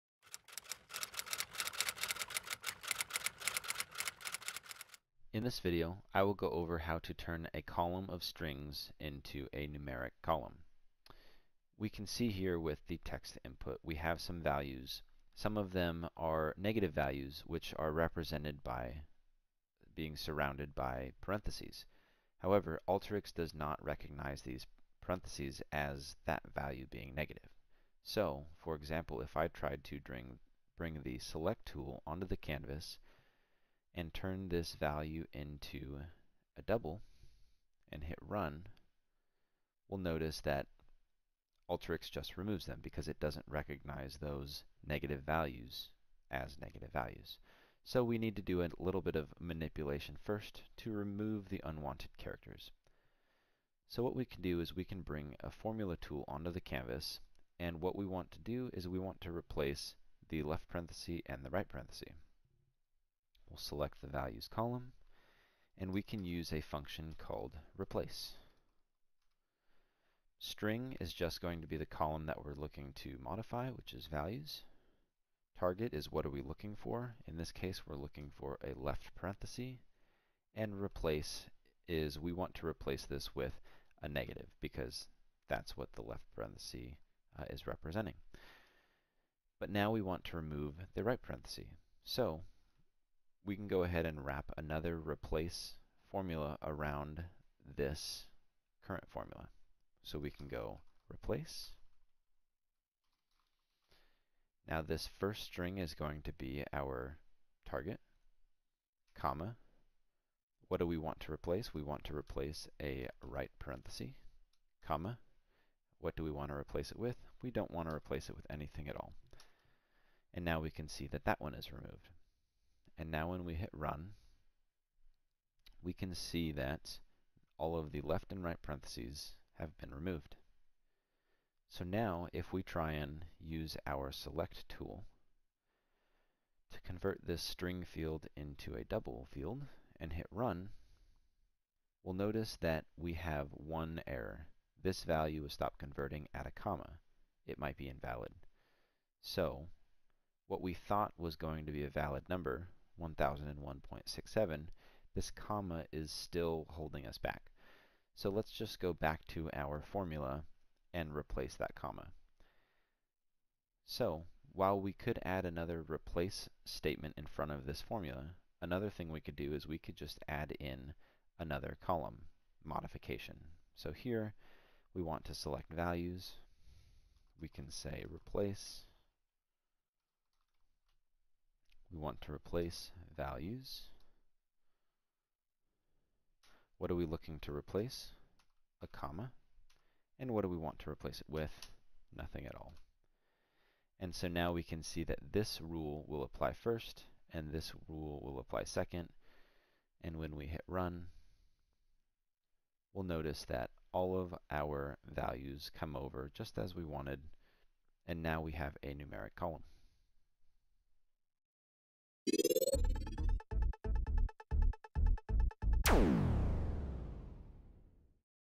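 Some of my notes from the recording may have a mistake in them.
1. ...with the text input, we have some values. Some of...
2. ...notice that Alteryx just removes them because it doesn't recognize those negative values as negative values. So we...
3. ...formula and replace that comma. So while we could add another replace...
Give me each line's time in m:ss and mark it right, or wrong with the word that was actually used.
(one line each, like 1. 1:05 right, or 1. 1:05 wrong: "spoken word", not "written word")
1. 0:12 right
2. 0:39 right
3. 2:39 right.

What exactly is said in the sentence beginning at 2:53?
So here we want to select values.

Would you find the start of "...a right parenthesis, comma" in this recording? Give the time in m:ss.
1:52.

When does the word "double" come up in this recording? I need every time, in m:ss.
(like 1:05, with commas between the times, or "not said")
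0:36, 2:18.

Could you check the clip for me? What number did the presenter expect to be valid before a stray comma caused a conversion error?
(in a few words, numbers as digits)
1001.67.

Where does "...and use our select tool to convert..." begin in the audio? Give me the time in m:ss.
2:12.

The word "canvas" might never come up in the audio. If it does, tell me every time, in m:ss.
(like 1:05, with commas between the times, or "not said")
0:32, 0:56.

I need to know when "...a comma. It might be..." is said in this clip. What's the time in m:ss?
2:26.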